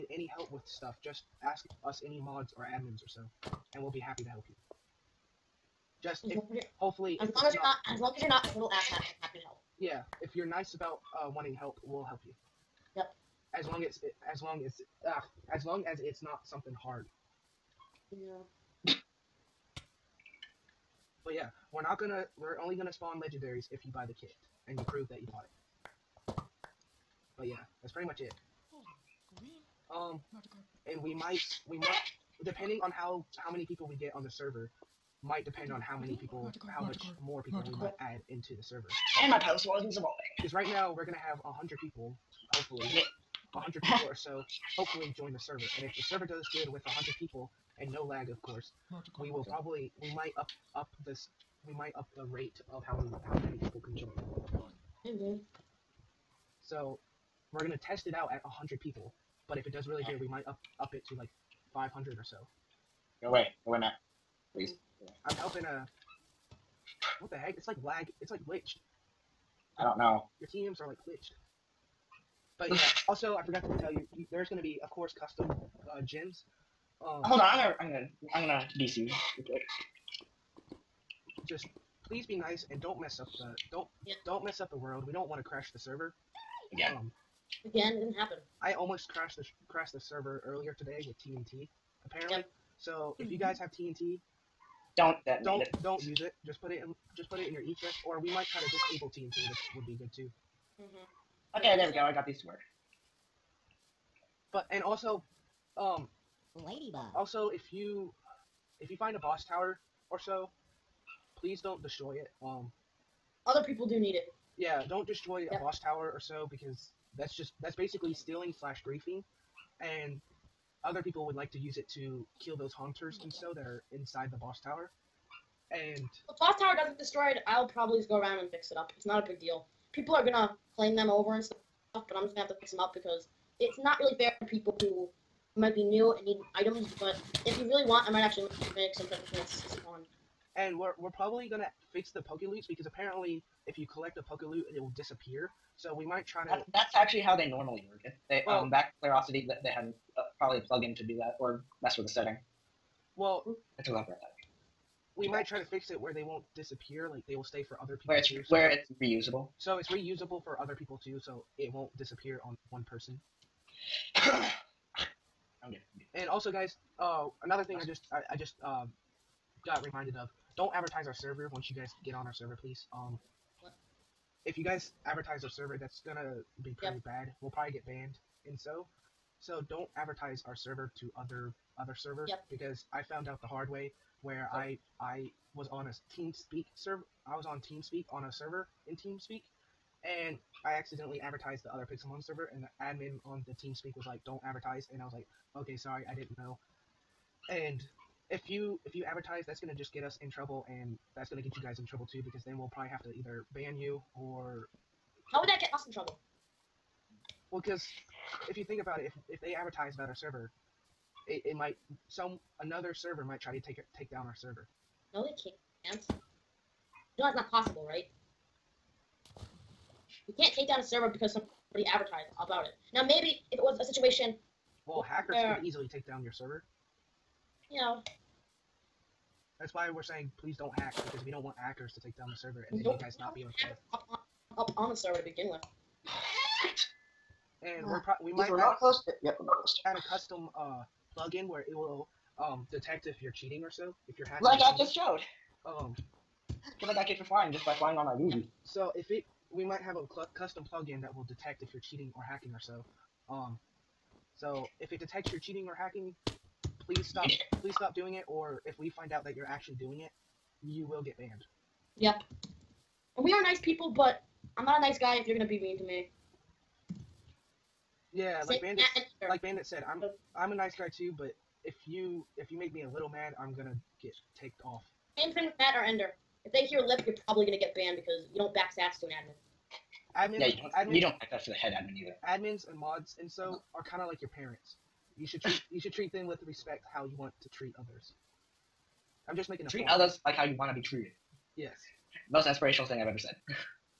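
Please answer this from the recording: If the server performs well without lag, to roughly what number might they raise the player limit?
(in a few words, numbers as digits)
500.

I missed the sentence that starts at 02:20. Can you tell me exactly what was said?
And we're we're probably gonna fix the Poke because apparently if you collect a Poke Loot, it will disappear.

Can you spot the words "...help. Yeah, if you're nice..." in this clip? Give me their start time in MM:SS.
00:09.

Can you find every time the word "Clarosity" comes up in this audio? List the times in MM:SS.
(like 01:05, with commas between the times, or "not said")
02:29.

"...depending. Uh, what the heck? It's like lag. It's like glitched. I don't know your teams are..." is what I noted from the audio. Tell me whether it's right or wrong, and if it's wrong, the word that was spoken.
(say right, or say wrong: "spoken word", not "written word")
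wrong: "helping", not "depending".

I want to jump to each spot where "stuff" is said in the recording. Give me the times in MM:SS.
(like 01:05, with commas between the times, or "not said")
00:00, 02:11.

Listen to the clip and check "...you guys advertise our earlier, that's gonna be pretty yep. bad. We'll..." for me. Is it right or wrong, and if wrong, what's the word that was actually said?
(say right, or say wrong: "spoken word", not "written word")
wrong: "server", not "earlier".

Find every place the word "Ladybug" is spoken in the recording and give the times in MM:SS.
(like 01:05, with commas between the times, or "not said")
01:46.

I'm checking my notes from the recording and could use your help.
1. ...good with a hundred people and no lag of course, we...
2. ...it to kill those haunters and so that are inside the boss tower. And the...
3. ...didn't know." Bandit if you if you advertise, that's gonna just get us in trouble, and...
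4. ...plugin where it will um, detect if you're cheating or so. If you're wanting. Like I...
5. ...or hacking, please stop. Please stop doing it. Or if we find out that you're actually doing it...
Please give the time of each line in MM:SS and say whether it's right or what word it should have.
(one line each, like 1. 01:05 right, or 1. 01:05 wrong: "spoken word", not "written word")
1. 00:46 right
2. 02:01 right
3. 03:16 wrong: "And", not "Bandit"
4. 04:01 wrong: "hacking", not "wanting"
5. 04:15 right.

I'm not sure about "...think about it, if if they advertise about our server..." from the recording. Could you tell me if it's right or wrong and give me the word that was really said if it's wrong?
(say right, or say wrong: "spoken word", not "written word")
right.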